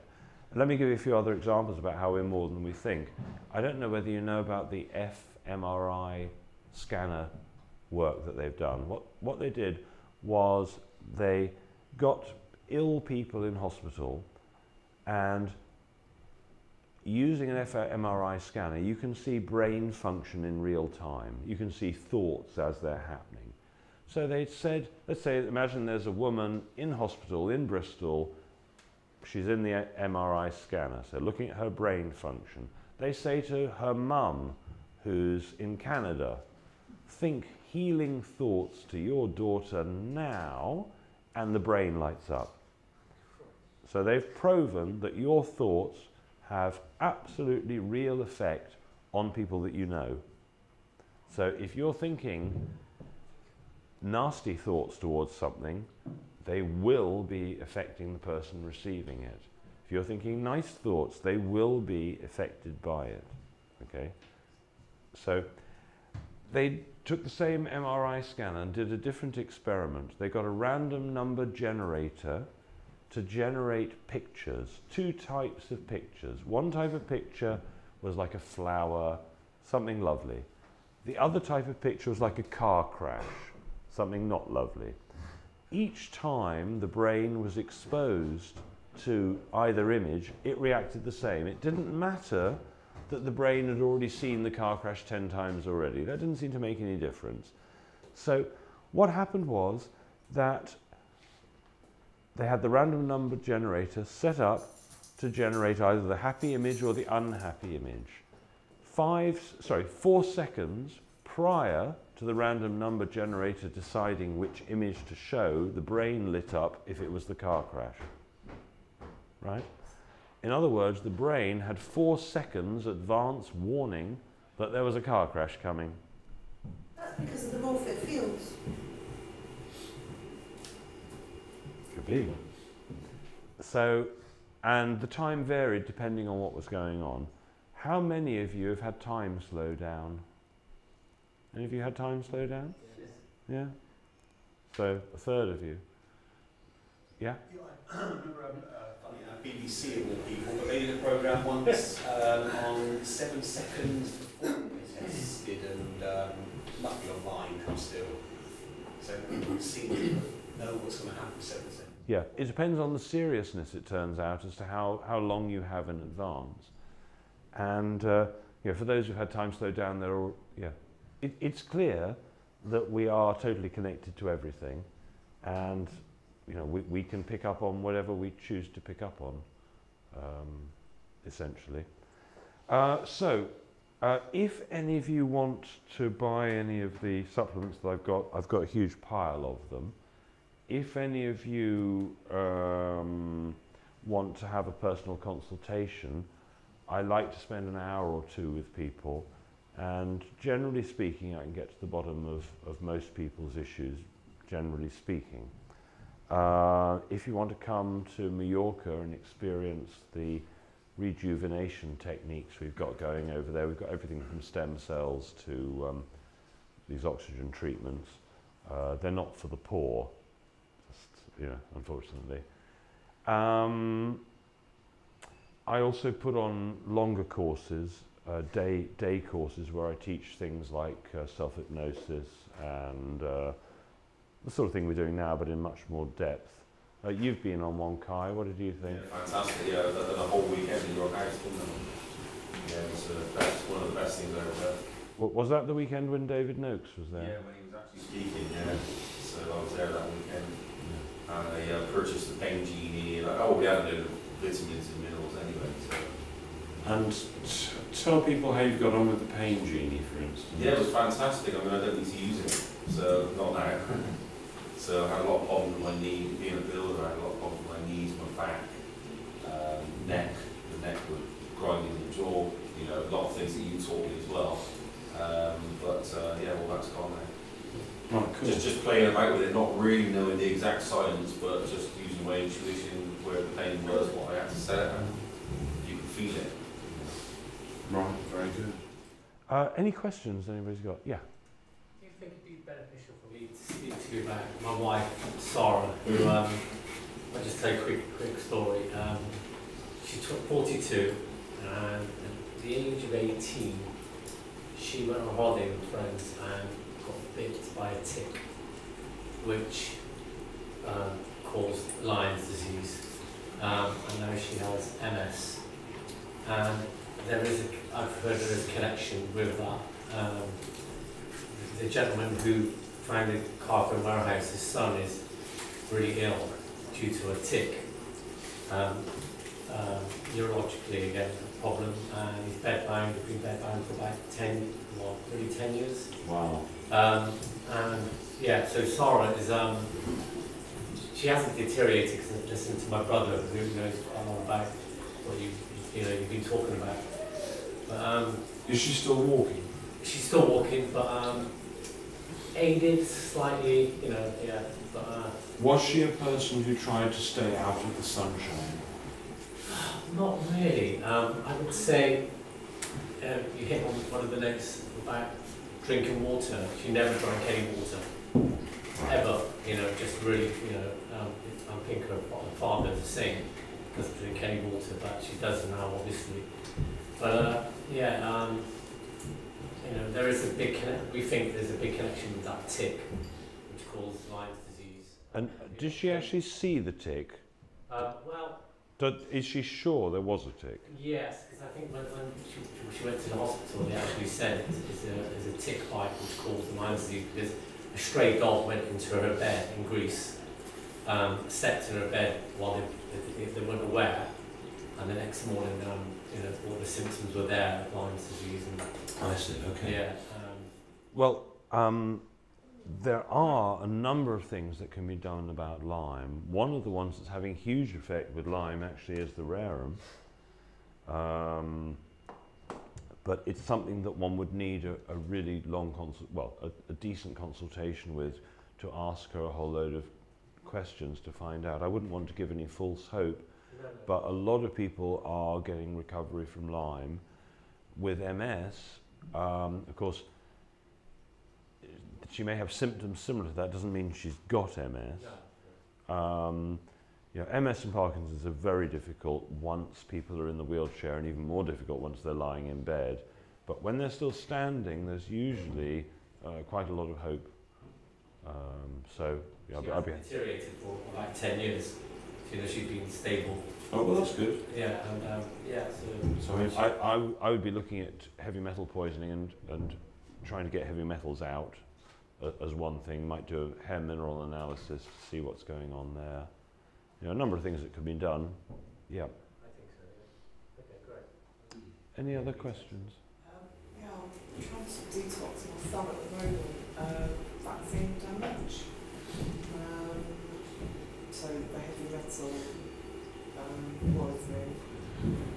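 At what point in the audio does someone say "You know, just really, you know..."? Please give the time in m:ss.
6:09.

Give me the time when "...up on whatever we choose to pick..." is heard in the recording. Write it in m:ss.
2:57.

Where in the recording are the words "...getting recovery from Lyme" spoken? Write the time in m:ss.
7:15.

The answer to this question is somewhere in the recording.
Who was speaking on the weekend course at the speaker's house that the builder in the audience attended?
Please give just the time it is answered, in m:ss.
4:06.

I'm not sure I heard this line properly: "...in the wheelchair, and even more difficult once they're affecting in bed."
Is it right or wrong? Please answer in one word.
wrong.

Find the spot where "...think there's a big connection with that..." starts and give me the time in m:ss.
6:21.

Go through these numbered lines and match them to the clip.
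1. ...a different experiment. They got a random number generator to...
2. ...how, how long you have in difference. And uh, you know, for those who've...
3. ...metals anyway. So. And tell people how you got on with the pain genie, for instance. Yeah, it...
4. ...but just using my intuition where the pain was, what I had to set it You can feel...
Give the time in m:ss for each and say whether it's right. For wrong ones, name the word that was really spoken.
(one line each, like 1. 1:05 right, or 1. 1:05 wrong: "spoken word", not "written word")
1. 1:08 right
2. 2:44 wrong: "advance", not "difference"
3. 4:15 wrong: "minerals", not "metals"
4. 4:41 right.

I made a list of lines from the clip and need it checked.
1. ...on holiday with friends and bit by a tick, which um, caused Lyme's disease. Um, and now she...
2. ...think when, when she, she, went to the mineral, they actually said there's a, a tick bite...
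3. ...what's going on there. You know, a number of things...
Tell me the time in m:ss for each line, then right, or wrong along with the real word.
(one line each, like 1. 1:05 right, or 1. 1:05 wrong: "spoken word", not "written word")
1. 5:05 right
2. 6:31 wrong: "hospital", not "mineral"
3. 7:55 right.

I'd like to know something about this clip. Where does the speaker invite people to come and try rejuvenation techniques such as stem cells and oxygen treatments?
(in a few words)
Mallorca.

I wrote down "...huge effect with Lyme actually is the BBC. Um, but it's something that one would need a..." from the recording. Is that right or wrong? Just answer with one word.
wrong.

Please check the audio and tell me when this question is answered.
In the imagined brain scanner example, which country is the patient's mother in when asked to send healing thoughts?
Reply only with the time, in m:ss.
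0:35.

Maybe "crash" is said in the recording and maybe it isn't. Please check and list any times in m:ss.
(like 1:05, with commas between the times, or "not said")
1:22, 1:34, 1:57, 2:05.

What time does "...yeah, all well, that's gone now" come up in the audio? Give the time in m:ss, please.
4:36.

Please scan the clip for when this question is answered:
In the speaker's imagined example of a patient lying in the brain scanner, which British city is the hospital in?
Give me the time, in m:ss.
0:27.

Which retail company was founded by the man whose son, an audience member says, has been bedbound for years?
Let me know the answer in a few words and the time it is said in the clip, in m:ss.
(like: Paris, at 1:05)
Carpet Warehouse, at 5:23.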